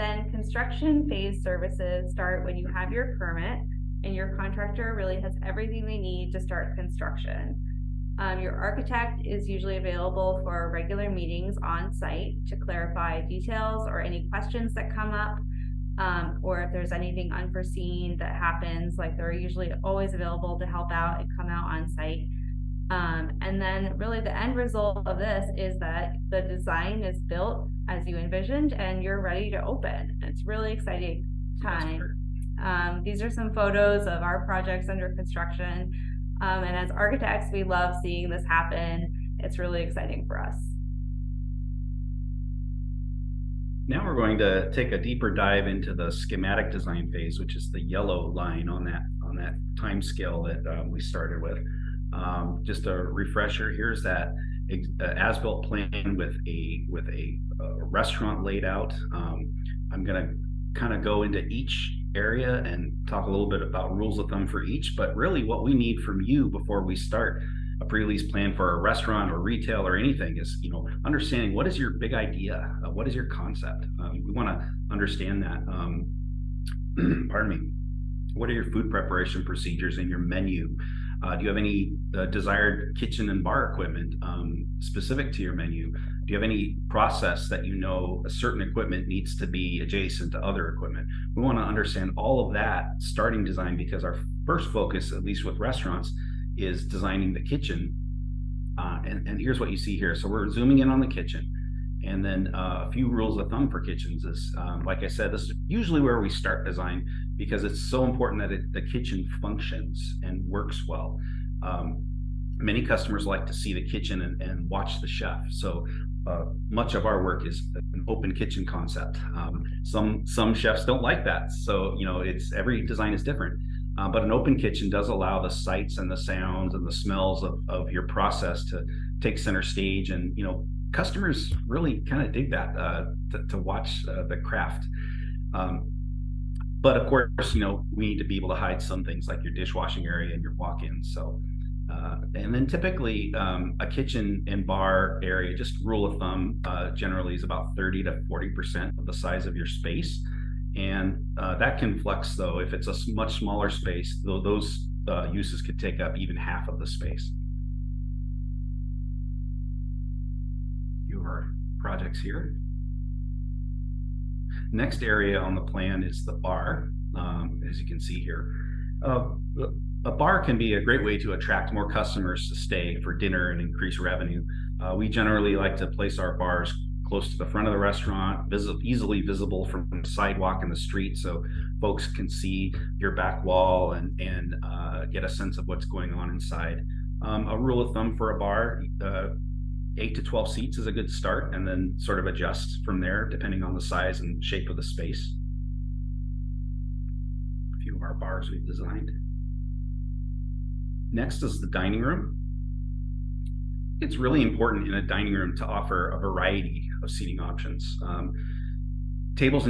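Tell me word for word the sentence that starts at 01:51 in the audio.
Um, many customers like to see the kitchen and, and watch the chef.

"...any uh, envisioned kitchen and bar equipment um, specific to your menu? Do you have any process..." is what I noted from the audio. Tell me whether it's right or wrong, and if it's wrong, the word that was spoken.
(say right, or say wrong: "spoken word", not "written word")
wrong: "desired", not "envisioned".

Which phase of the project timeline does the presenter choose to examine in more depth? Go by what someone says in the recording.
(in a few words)
Schematic design.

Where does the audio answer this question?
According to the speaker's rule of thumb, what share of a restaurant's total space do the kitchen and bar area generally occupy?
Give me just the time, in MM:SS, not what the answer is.
02:27.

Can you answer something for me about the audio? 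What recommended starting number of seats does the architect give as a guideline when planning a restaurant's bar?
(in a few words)
8 to 12.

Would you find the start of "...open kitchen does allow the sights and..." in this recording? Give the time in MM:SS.
02:04.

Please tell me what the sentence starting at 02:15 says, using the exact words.
Um, but of course, you know, we need to be able to hide some things like your dishwashing area and your walk-in.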